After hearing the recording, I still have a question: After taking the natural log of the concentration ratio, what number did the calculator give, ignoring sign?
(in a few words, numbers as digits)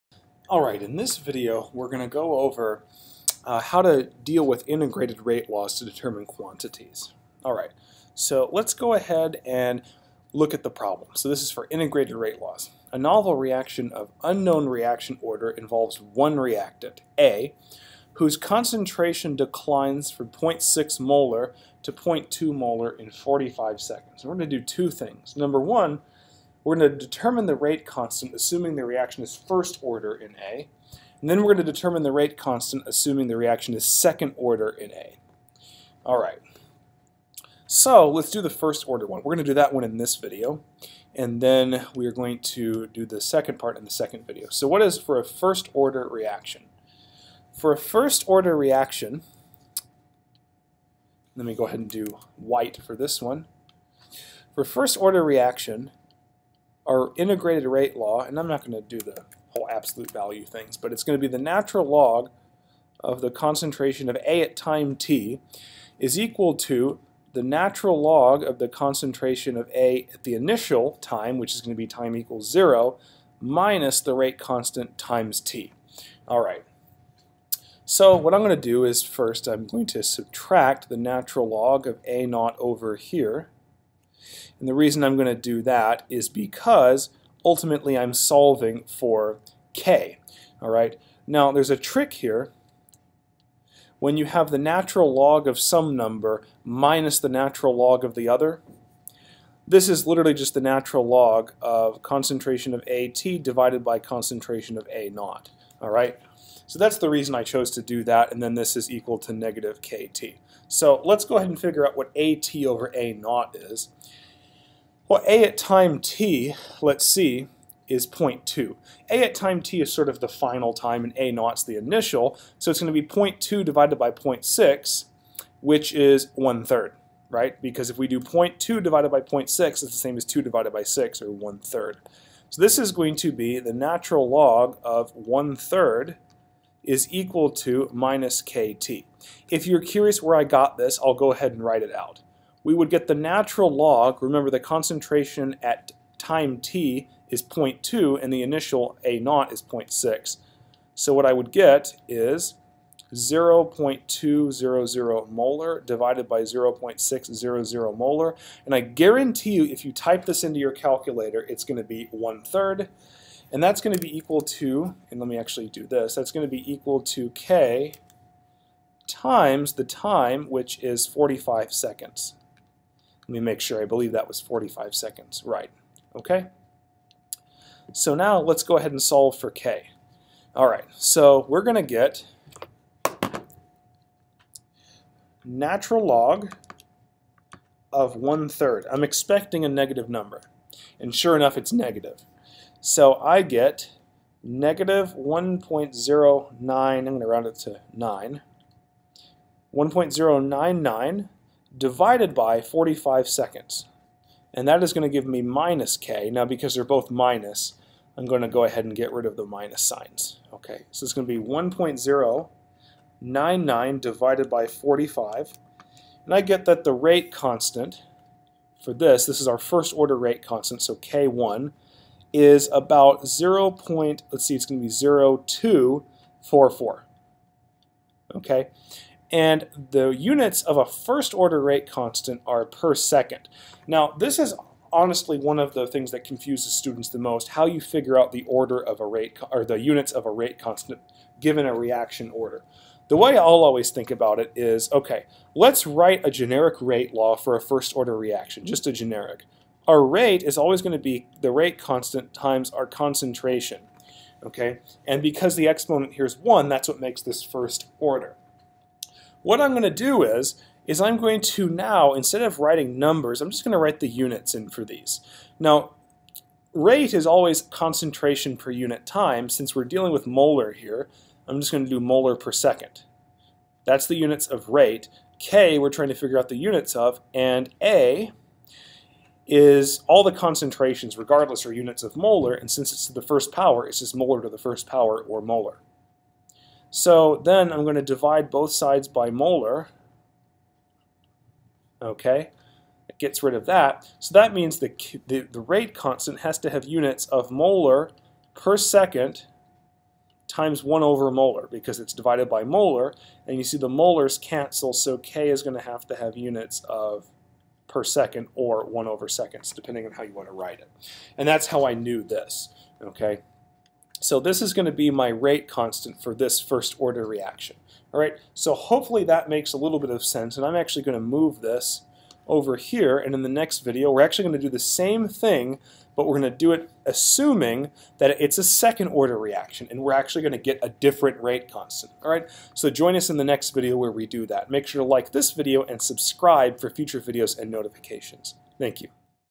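1.099.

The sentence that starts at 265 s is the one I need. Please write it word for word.
Now, rate is always concentration per unit time.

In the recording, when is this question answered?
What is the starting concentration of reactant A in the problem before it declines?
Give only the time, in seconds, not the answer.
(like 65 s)
20 s.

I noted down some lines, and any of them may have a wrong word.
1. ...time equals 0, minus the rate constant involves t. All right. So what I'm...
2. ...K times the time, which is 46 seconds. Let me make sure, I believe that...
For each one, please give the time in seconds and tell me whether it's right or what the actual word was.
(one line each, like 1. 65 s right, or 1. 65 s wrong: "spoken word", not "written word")
1. 71 s wrong: "times", not "involves"
2. 167 s wrong: "45", not "46".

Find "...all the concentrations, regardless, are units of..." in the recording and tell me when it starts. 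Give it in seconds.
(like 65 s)
280 s.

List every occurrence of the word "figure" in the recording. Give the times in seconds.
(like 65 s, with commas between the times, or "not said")
111 s, 237 s, 276 s.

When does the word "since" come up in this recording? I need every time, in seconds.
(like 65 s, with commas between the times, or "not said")
269 s, 282 s.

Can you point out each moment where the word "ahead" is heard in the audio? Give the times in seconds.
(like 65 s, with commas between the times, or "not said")
8 s, 51 s, 111 s, 141 s, 178 s, 208 s.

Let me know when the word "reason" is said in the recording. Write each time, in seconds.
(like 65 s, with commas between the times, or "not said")
84 s, 107 s.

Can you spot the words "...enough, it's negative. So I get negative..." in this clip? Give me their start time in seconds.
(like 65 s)
191 s.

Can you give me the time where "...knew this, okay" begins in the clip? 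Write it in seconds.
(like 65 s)
311 s.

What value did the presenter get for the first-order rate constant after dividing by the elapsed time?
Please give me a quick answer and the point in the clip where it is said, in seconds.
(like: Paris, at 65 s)
0.244, at 224 s.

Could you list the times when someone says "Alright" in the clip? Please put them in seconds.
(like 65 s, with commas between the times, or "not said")
0 s, 7 s.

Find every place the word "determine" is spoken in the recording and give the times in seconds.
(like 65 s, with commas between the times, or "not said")
5 s, 26 s, 31 s.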